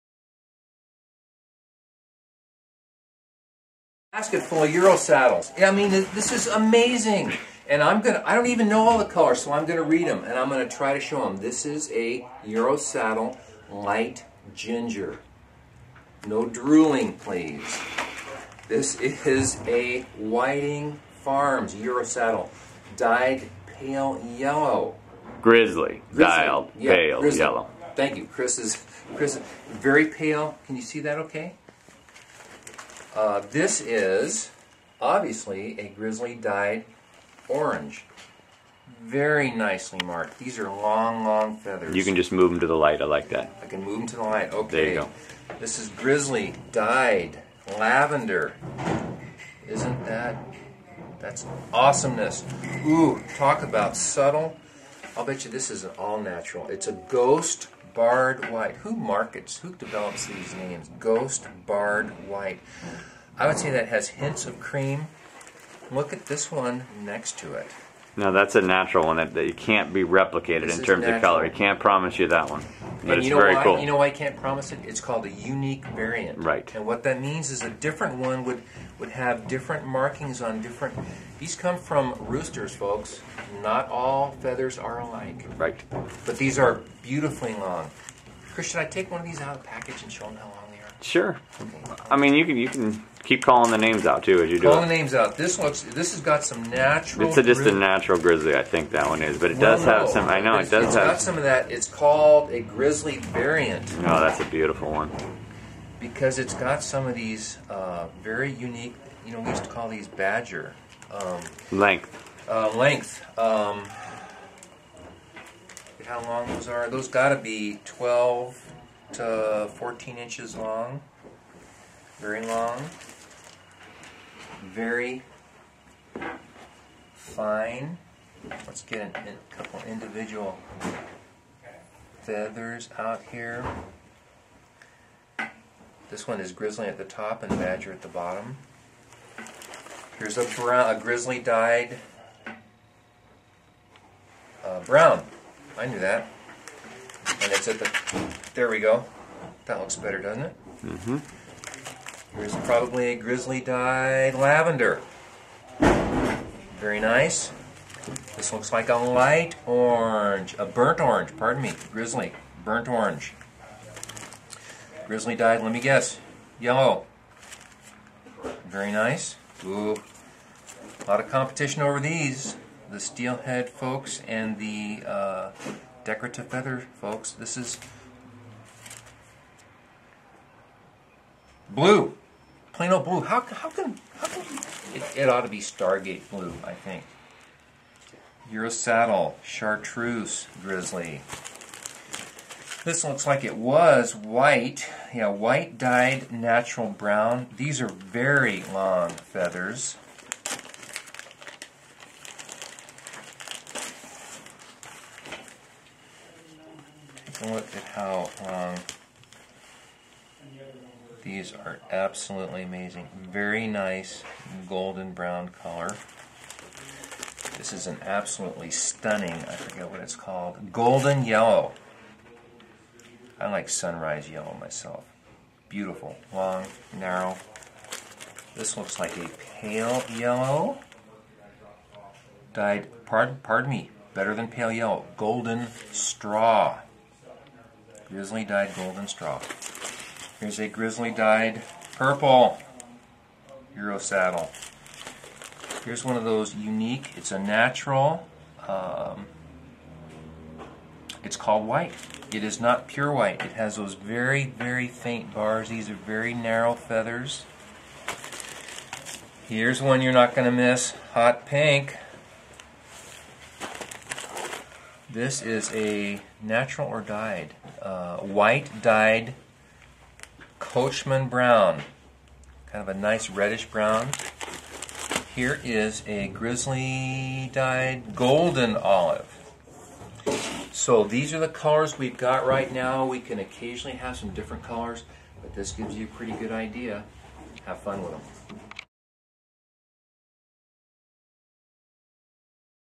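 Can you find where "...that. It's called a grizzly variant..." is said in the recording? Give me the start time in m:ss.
1:41.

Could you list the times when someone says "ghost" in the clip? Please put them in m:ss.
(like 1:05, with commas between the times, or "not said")
0:56, 1:00.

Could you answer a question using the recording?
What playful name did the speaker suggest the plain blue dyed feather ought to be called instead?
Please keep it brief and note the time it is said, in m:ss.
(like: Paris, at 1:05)
Stargate blue, at 3:05.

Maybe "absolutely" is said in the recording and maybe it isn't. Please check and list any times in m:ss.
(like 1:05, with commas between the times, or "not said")
3:31, 3:38.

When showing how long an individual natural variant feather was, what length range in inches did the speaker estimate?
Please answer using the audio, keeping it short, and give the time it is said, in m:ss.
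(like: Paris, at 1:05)
12 to 14 inches, at 1:57.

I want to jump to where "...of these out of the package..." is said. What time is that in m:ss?
1:29.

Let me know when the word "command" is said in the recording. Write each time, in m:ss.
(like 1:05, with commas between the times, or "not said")
not said.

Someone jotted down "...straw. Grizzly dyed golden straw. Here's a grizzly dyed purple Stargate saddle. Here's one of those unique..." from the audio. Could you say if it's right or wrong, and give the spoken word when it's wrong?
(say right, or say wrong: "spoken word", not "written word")
wrong: "Euro", not "Stargate".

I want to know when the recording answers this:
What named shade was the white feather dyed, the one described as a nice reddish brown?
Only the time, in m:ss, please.
4:30.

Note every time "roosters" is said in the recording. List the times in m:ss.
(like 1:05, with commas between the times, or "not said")
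1:22.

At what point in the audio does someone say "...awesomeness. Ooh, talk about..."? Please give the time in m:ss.
0:51.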